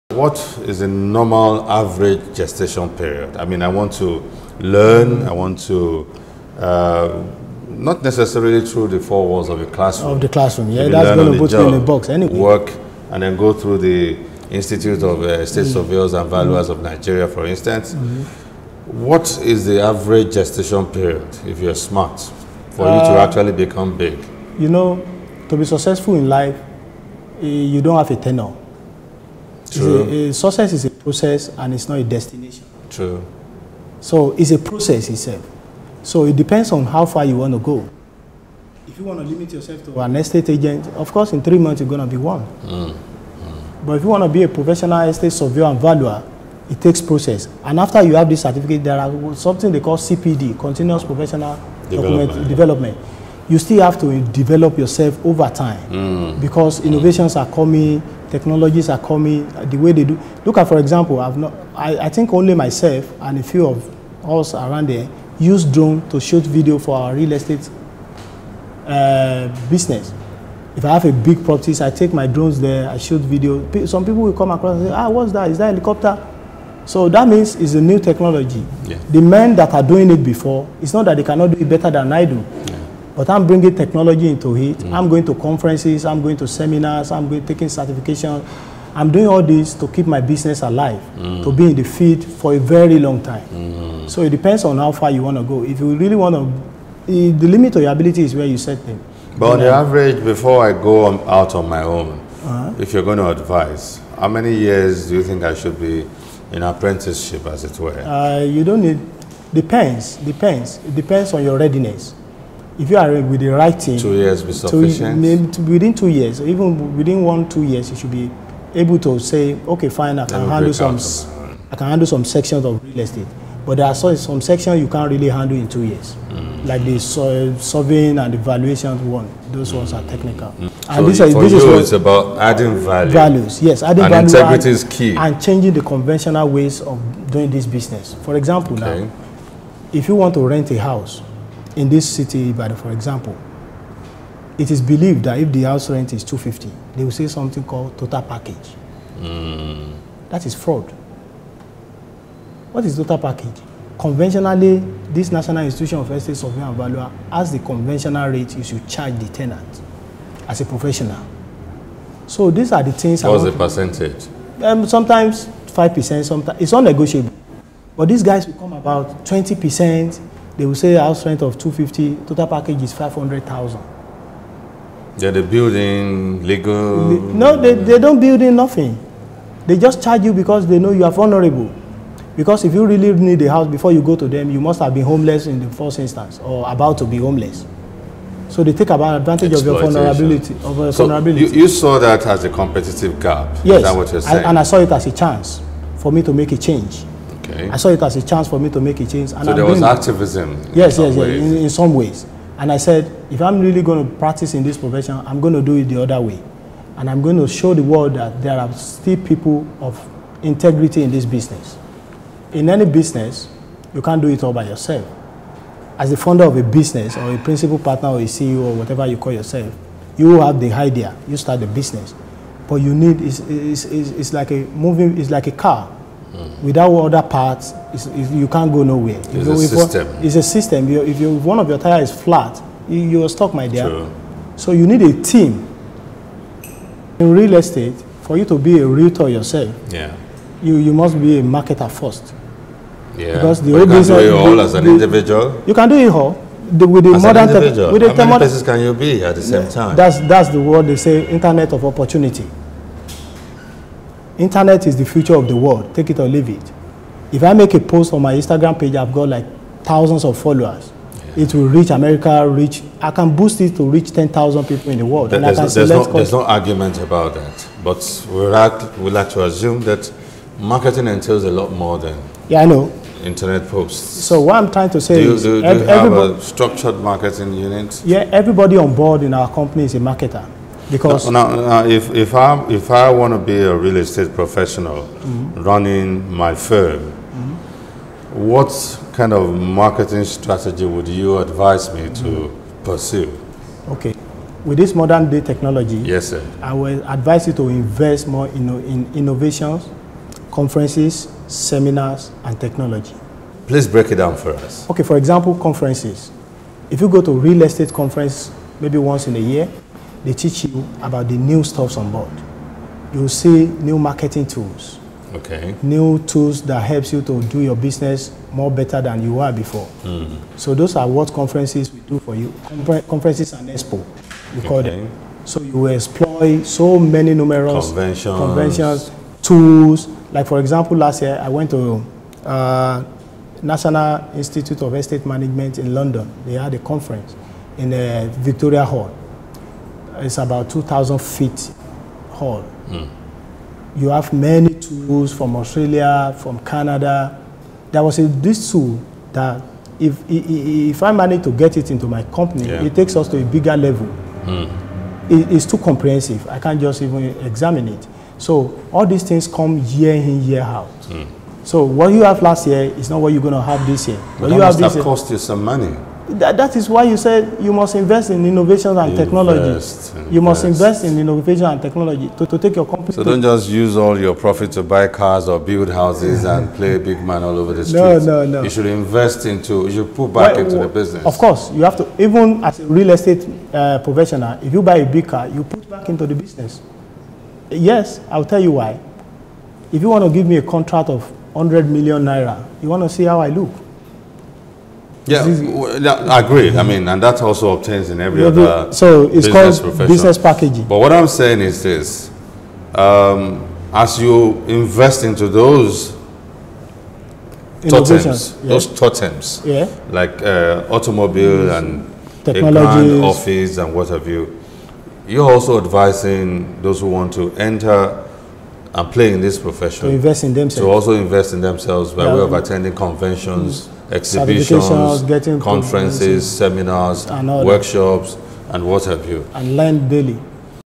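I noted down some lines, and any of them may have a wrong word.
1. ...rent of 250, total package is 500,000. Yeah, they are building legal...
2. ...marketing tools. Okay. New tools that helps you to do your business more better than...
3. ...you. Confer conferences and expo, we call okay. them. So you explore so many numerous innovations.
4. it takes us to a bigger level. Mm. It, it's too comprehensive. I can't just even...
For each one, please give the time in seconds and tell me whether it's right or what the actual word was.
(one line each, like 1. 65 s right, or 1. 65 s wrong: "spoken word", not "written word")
1. 171 s right
2. 313 s right
3. 322 s wrong: "conventions", not "innovations"
4. 352 s right.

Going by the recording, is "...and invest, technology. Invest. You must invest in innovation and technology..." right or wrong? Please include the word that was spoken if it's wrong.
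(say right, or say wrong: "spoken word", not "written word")
right.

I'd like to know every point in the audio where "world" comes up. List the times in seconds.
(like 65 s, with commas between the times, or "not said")
207 s, 255 s, 265 s.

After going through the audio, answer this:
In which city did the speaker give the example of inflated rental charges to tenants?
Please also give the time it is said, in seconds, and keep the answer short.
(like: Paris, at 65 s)
Ibadan, at 142 s.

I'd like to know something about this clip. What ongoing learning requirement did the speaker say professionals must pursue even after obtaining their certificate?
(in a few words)
Continuous Professional Development.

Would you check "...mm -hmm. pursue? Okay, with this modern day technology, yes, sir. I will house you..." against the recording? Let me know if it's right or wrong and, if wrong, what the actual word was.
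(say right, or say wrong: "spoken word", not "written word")
wrong: "advise", not "house".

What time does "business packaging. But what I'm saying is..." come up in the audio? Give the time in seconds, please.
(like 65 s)
400 s.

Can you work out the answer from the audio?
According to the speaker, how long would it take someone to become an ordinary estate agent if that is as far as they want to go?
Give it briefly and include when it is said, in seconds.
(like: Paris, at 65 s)
3 months, at 41 s.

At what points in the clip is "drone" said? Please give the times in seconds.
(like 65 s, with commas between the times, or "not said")
65 s, 72 s.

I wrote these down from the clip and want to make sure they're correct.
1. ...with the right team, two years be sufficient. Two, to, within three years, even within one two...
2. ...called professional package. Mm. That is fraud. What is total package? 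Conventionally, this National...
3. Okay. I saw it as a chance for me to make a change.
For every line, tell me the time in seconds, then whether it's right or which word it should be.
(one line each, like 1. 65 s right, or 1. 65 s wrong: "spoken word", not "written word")
1. 113 s wrong: "two", not "three"
2. 147 s wrong: "total", not "professional"
3. 197 s right.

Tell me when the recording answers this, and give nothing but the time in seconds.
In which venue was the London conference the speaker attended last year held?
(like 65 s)
338 s.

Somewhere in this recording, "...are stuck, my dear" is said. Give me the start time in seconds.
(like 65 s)
233 s.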